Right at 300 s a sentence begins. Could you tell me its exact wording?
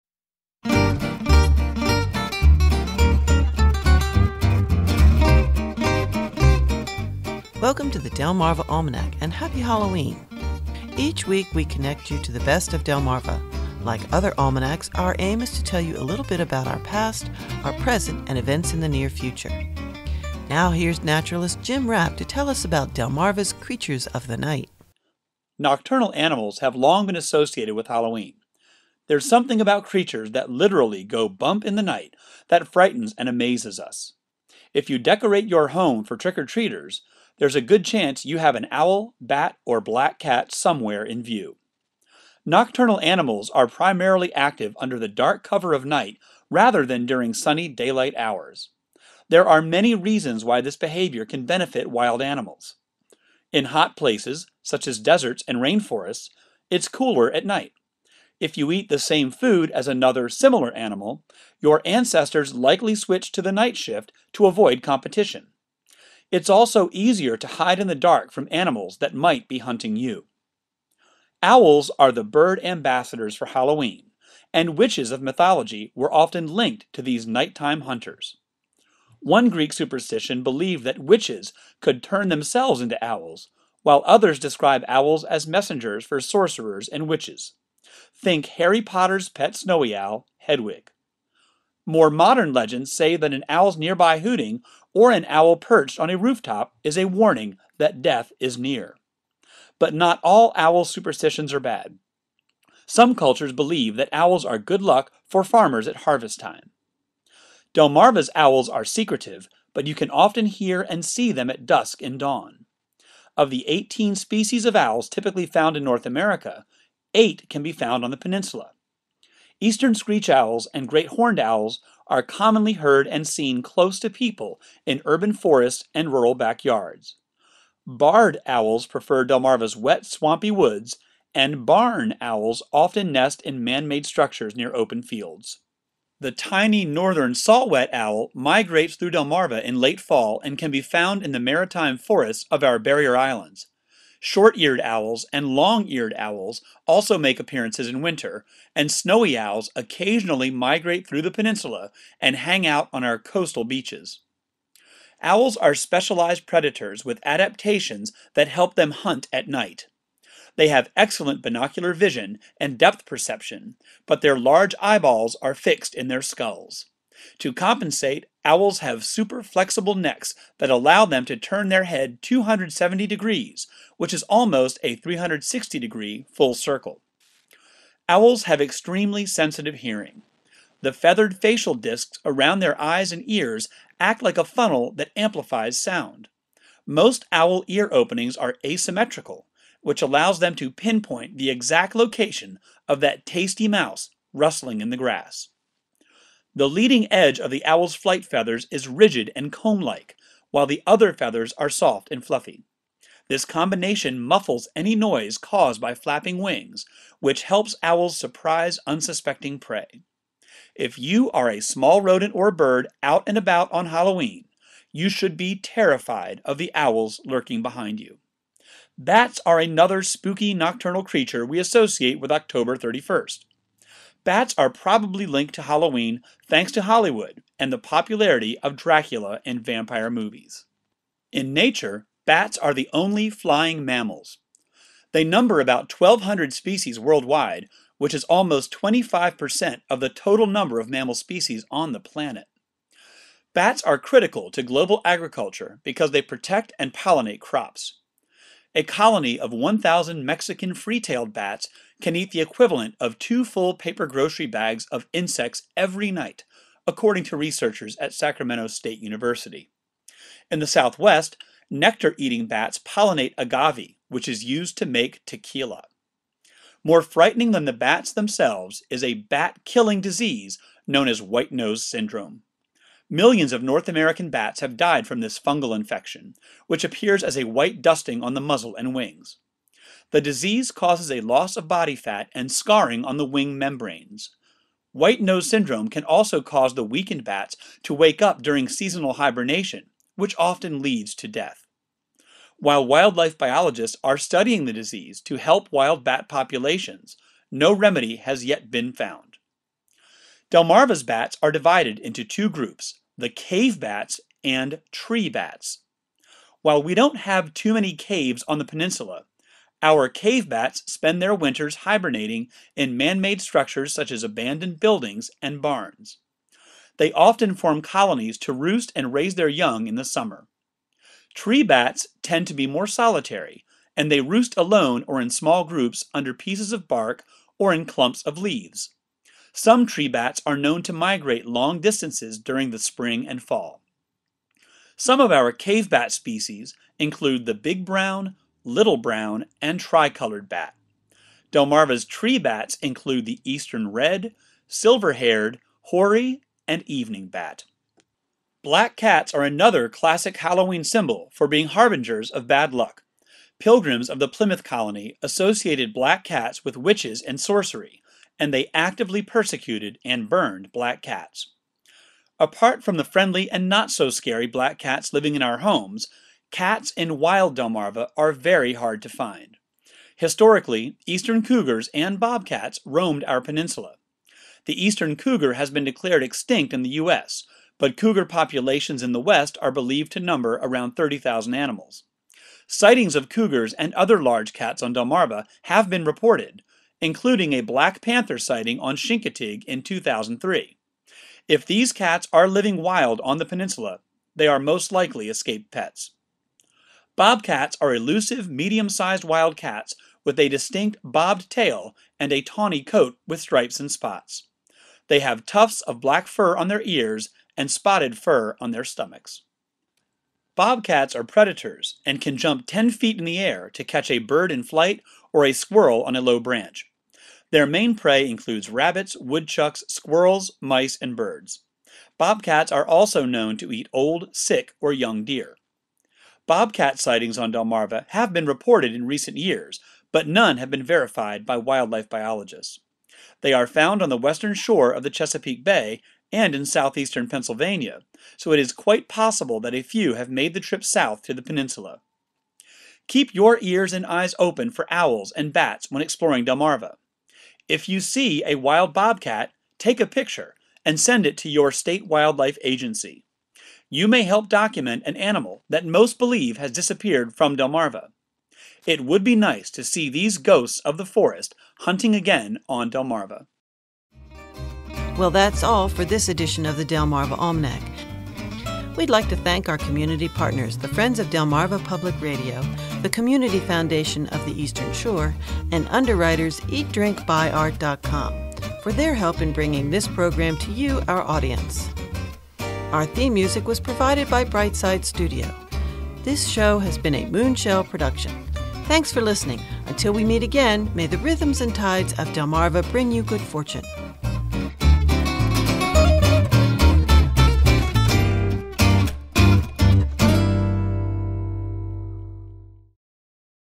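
Delmarva's bats are divided into two groups, the cave bats and tree bats.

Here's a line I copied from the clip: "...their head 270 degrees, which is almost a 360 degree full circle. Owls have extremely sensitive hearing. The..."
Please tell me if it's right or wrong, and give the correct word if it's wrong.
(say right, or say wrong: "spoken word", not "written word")
right.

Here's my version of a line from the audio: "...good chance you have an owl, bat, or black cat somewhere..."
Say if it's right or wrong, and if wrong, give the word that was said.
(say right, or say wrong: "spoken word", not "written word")
right.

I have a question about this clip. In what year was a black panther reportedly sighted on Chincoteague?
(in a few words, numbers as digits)
2003.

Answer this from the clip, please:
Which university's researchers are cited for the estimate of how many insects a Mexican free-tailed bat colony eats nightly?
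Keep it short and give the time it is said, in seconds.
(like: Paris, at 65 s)
Sacramento State University, at 258 s.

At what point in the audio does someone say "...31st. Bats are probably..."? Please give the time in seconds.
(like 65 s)
222 s.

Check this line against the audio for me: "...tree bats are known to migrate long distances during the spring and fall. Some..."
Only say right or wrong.
right.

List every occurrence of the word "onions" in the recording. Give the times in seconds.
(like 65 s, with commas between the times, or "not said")
not said.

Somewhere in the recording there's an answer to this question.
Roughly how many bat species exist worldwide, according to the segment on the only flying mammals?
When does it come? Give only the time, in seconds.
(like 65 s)
235 s.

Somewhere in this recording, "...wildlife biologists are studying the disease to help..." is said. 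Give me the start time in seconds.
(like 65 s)
292 s.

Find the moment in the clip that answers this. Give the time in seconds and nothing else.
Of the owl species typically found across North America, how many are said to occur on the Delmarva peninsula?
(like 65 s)
117 s.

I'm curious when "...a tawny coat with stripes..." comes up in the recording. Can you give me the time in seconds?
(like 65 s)
402 s.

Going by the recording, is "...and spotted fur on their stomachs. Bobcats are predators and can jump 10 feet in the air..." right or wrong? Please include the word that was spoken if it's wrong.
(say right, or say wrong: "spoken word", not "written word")
right.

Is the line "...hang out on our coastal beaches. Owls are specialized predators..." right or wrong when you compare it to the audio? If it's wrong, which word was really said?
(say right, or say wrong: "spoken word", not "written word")
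right.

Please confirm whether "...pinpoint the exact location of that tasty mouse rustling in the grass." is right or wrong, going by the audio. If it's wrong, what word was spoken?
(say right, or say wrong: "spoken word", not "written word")
right.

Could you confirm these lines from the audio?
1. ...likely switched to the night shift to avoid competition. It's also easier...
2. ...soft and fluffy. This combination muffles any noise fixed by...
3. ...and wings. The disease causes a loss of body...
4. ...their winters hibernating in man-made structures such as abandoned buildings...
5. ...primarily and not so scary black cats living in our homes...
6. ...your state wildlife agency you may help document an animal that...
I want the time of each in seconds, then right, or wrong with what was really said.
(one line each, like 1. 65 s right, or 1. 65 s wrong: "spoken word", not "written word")
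1. 62 s right
2. 201 s wrong: "caused", not "fixed"
3. 278 s right
4. 311 s right
5. 363 s wrong: "friendly", not "primarily"
6. 451 s right.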